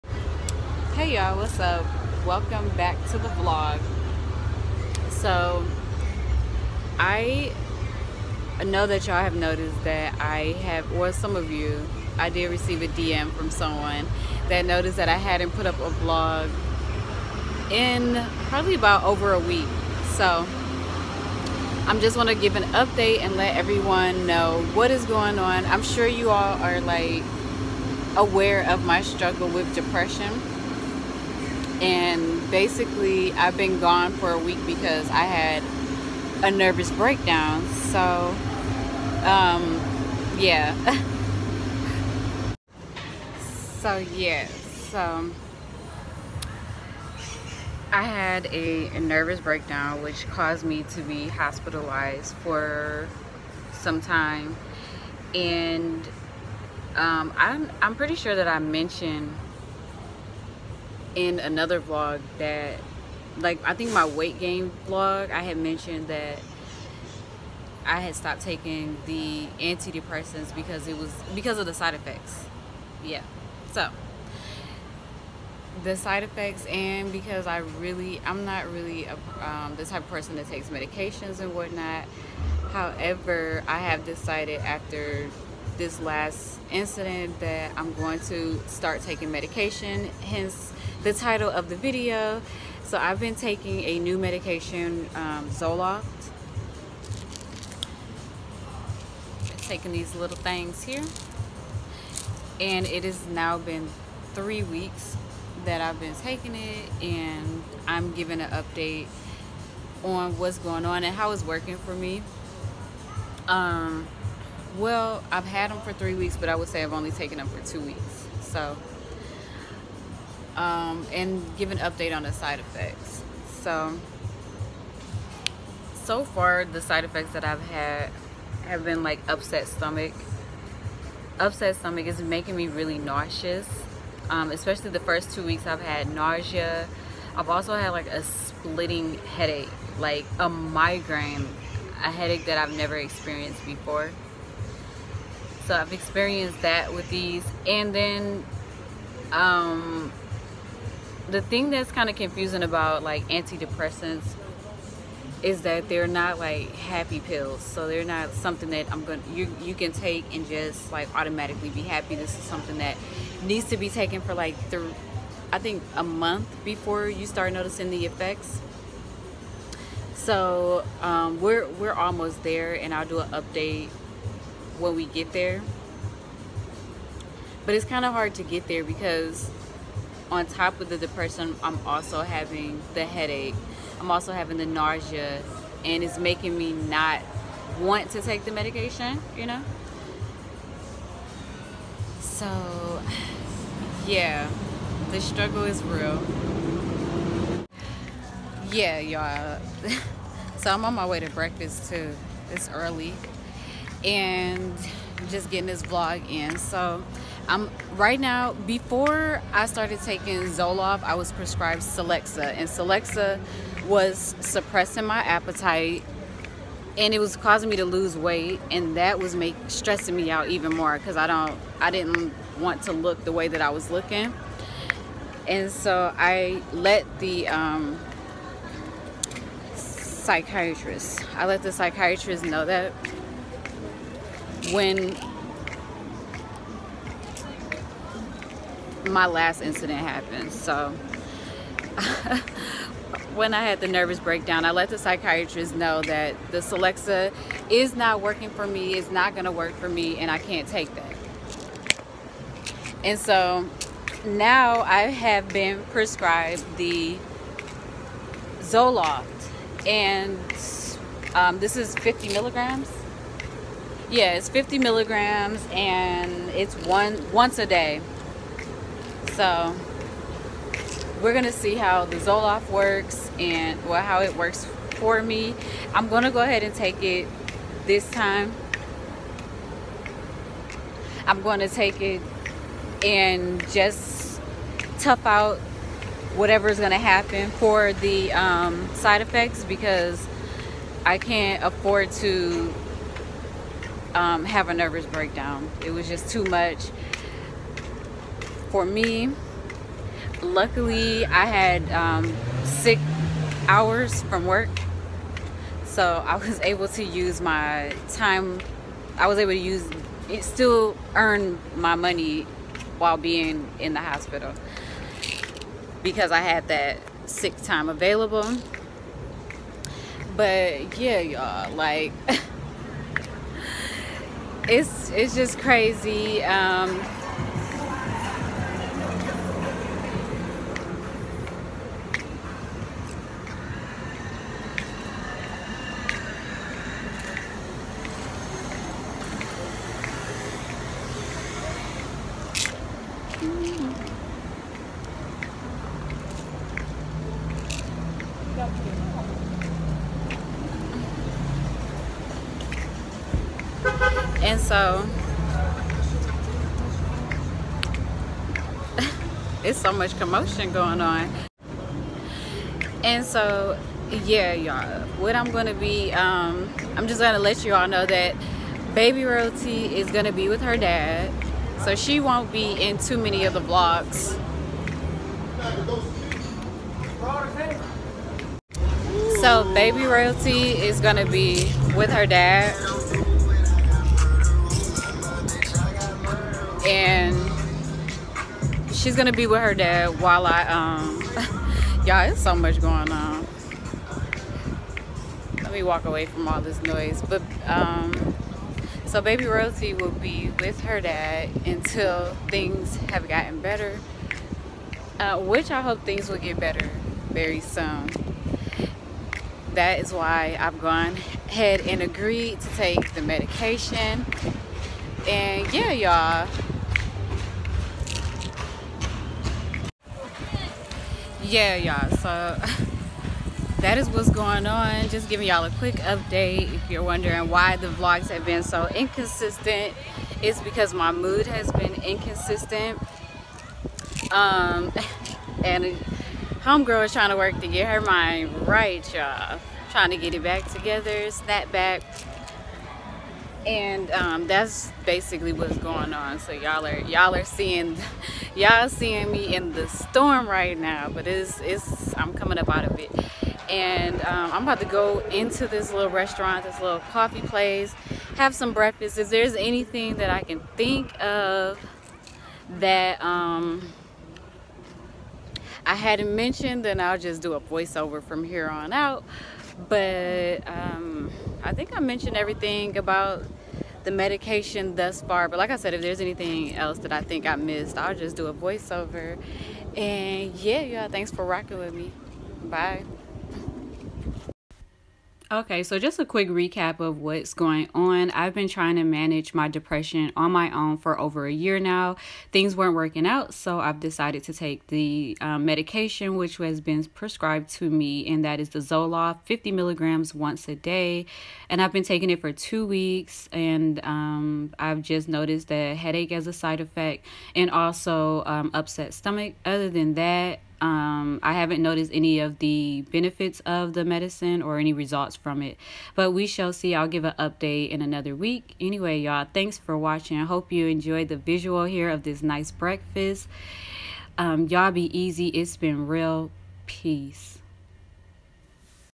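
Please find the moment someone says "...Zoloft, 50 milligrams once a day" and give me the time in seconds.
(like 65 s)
498 s.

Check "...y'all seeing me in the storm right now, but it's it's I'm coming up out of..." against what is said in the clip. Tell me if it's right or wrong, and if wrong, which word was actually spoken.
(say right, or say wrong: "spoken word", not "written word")
right.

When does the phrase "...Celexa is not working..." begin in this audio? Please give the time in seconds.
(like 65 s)
246 s.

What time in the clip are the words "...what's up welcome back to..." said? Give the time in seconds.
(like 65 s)
1 s.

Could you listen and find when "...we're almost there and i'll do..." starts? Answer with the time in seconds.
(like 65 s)
171 s.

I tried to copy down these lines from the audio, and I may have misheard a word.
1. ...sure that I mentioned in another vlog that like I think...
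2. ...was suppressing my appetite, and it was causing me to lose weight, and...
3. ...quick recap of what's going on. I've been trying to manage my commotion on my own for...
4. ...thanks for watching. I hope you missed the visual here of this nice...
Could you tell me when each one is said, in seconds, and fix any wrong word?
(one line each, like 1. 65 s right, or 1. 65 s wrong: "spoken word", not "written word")
1. 58 s right
2. 213 s right
3. 486 s wrong: "depression", not "commotion"
4. 519 s wrong: "enjoyed", not "missed".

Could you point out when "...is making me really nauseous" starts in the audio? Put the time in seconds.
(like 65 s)
132 s.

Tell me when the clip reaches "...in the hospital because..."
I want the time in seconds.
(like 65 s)
313 s.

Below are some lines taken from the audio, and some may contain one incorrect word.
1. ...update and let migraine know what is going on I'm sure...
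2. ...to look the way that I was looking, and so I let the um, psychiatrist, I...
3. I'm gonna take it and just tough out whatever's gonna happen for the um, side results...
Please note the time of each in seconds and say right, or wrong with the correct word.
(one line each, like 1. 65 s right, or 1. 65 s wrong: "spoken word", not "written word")
1. 22 s wrong: "everyone", not "migraine"
2. 222 s right
3. 281 s wrong: "effects", not "results".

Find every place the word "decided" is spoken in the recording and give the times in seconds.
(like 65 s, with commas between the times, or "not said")
84 s, 493 s.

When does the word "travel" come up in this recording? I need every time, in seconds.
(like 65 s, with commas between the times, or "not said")
not said.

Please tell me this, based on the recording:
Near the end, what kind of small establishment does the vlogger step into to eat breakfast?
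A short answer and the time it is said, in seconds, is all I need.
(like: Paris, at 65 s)
coffee place, at 457 s.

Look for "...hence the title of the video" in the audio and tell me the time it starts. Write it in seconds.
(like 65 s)
90 s.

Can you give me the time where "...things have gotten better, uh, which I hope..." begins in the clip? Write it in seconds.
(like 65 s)
402 s.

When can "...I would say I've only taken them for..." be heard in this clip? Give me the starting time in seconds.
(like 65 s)
116 s.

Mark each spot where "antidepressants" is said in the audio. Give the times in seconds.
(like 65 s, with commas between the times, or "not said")
69 s, 153 s.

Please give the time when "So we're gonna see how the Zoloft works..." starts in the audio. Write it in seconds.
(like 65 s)
269 s.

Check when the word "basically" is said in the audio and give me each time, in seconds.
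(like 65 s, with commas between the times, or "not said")
32 s, 445 s.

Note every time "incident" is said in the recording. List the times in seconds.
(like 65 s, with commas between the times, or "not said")
86 s, 239 s.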